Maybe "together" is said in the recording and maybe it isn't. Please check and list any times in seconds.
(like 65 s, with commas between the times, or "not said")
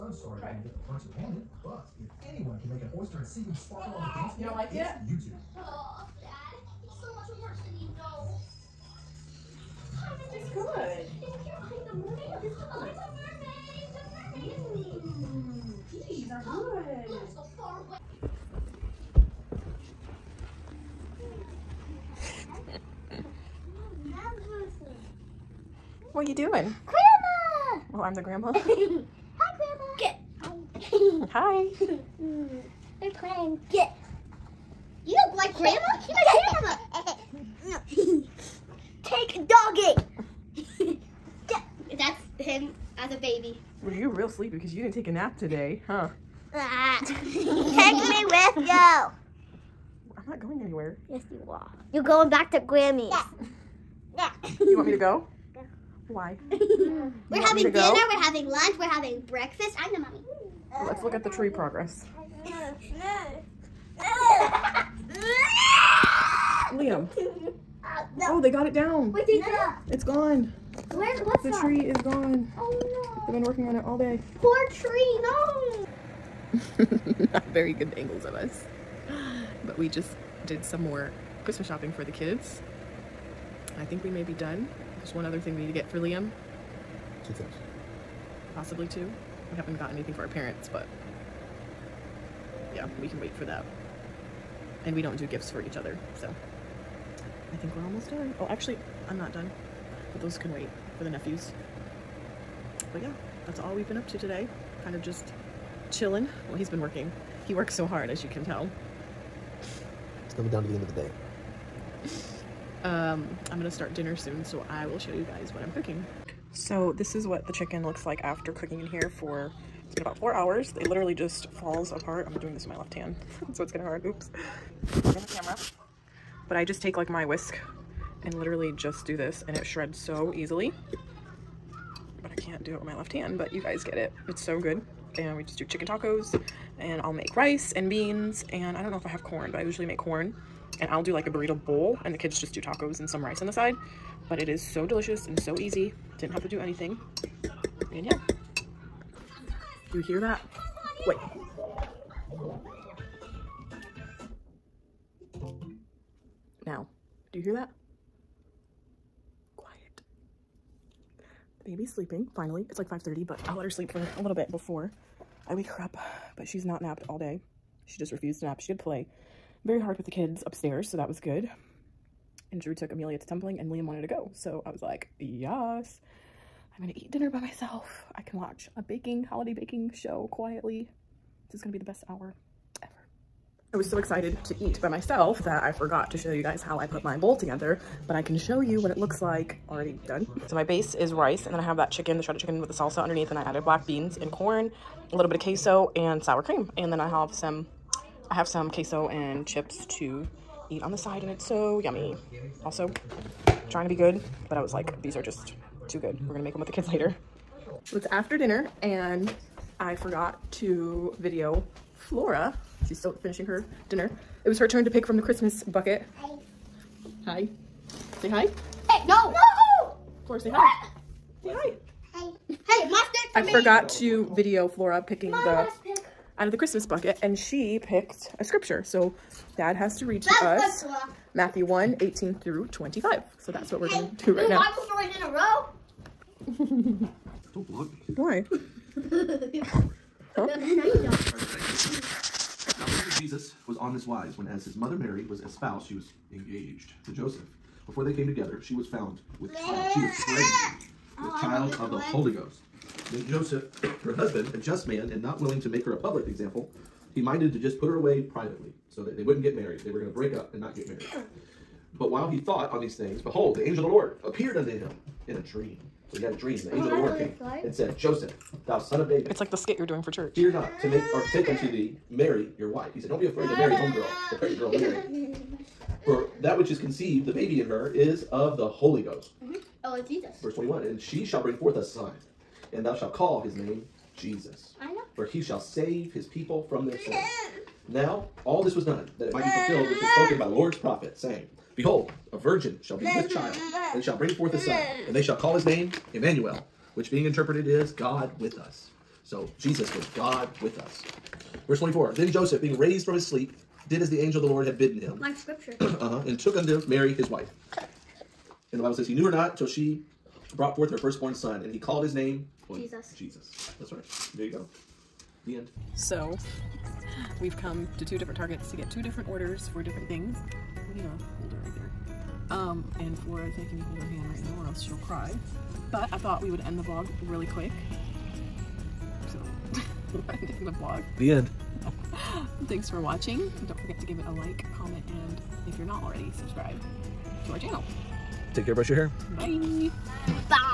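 187 s, 248 s.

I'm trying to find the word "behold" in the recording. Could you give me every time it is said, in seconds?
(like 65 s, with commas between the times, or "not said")
263 s, 291 s.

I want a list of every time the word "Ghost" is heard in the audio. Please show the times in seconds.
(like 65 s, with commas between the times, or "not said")
252 s, 279 s.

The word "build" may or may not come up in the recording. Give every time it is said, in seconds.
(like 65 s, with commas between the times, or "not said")
not said.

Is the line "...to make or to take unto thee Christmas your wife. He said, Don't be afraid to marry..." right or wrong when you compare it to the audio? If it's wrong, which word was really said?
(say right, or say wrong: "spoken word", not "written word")
wrong: "Mary", not "Christmas".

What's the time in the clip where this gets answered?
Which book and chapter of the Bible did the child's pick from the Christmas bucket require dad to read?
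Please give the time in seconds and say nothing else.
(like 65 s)
231 s.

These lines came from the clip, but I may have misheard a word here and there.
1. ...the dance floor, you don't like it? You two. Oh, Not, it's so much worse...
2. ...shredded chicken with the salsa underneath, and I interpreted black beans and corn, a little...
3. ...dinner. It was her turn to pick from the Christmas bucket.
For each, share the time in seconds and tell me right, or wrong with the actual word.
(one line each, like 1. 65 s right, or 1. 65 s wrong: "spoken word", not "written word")
1. 4 s wrong: "Dad", not "Not"
2. 192 s wrong: "added", not "interpreted"
3. 213 s right.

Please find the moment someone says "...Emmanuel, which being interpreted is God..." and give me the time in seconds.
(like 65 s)
296 s.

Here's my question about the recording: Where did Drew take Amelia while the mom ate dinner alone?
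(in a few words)
tumbling.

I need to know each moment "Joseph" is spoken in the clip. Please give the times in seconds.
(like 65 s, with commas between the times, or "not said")
247 s, 253 s, 267 s, 302 s.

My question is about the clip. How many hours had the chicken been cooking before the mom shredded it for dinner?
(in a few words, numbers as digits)
4.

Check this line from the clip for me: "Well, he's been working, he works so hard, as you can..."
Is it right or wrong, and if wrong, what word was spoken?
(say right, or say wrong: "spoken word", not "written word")
right.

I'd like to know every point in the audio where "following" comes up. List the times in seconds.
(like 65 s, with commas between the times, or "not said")
not said.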